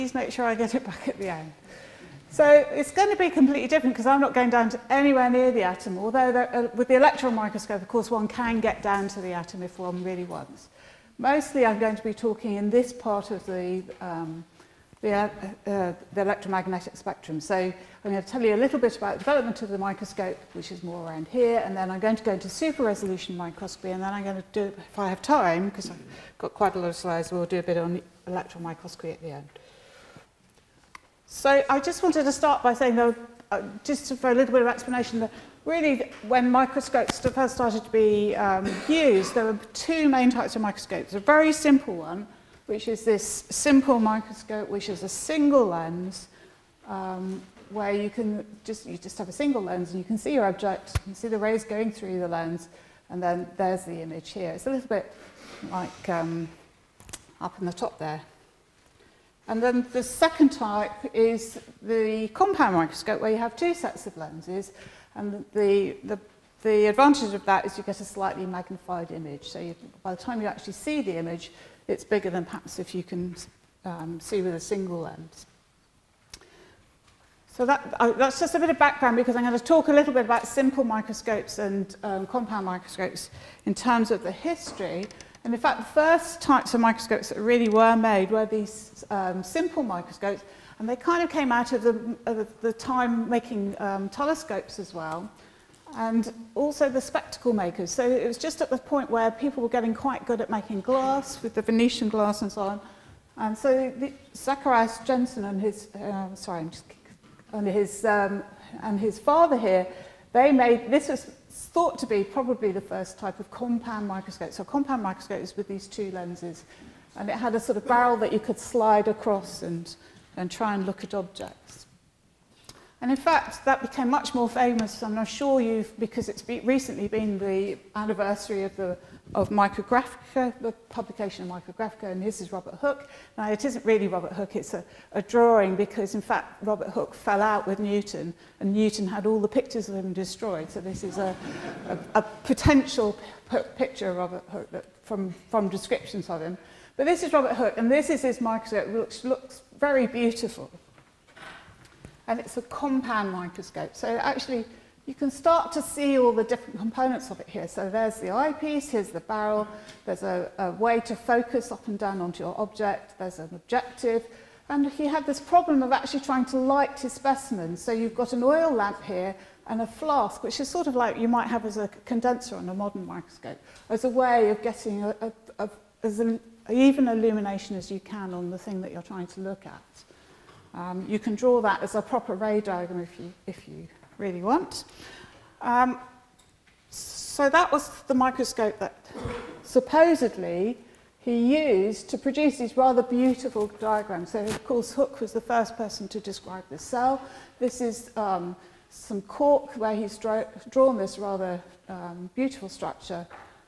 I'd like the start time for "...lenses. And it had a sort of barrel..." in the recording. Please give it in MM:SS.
01:56.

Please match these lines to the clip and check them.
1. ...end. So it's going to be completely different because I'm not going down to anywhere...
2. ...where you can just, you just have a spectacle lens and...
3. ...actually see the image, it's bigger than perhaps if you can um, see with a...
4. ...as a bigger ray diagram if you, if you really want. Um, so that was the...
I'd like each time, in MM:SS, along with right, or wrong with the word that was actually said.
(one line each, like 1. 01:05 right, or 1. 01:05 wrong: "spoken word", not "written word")
1. 00:01 right
2. 00:47 wrong: "single", not "spectacle"
3. 01:10 right
4. 03:01 wrong: "proper", not "bigger".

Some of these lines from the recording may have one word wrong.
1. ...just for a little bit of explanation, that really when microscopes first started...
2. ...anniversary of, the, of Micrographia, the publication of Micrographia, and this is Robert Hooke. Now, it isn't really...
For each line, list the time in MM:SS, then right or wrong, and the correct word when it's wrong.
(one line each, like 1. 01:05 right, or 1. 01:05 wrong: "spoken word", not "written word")
1. 00:33 right
2. 02:07 right.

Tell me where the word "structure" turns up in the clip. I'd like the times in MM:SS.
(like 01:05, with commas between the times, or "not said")
03:22.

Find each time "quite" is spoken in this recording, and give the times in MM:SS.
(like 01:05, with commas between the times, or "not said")
00:26, 01:39.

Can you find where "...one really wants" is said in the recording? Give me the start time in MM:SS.
00:09.